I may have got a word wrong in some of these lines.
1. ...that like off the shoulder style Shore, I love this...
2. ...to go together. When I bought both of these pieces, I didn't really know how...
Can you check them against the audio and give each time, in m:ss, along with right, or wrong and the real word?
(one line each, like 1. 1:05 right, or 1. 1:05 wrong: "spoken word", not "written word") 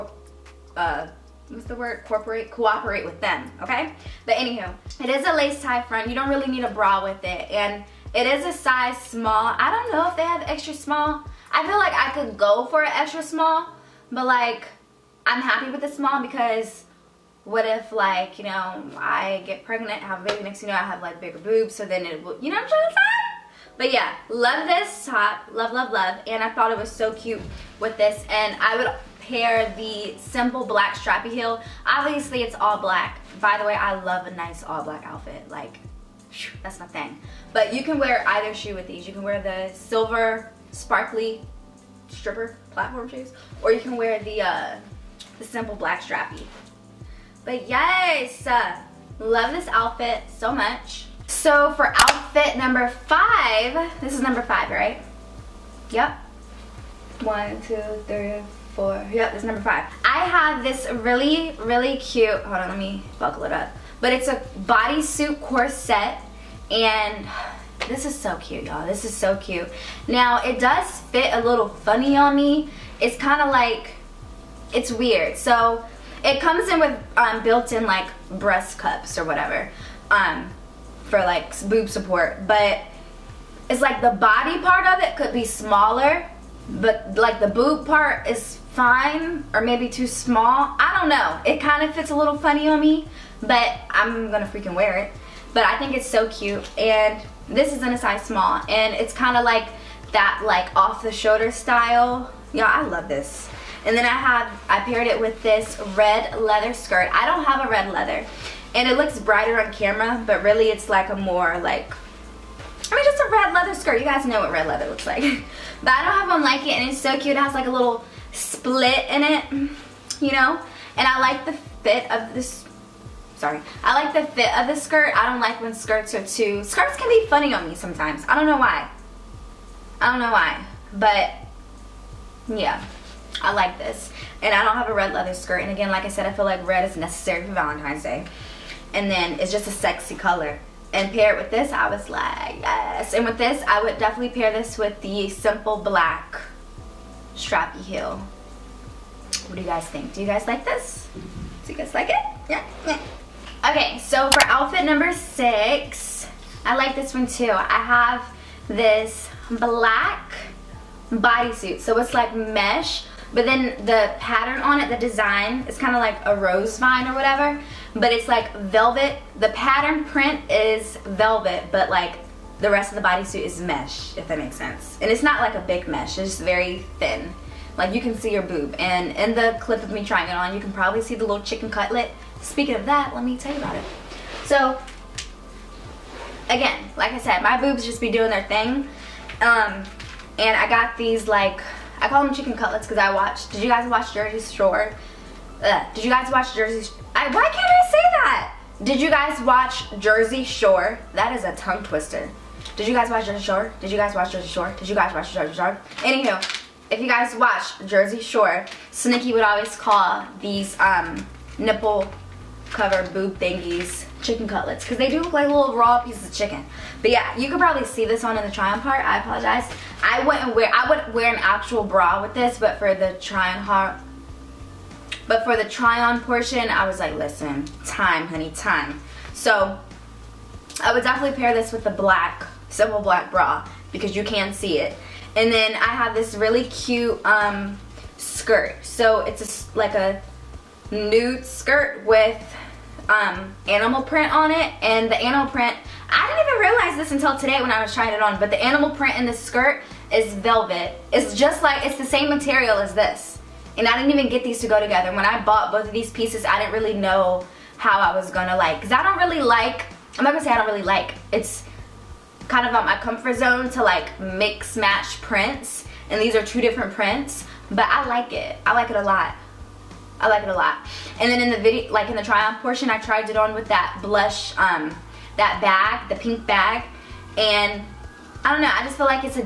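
1. 1:40 wrong: "Yeah", not "Shore"
2. 4:14 right.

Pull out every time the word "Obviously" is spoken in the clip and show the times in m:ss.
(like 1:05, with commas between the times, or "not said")
0:31.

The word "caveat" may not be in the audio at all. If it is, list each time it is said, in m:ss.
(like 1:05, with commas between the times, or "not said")
not said.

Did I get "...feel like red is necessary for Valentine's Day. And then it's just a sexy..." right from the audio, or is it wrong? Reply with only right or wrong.
right.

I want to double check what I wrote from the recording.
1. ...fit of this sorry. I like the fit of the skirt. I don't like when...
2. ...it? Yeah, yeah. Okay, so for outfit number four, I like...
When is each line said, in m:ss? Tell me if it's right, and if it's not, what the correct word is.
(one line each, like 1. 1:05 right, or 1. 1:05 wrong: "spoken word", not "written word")
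1. 2:01 right
2. 2:32 wrong: "six", not "four".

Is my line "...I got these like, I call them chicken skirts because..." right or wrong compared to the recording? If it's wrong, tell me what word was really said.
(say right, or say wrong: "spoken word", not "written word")
wrong: "cutlets", not "skirts".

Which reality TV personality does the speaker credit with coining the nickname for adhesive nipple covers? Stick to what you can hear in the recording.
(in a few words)
Snooki.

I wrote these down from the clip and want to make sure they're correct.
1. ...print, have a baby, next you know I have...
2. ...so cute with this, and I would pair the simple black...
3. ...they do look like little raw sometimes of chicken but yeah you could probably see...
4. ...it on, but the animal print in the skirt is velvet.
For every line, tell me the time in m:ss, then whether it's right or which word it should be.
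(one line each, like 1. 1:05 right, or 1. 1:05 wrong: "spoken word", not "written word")
1. 0:19 wrong: "pregnant", not "print"
2. 0:26 right
3. 3:34 wrong: "pieces", not "sometimes"
4. 4:08 right.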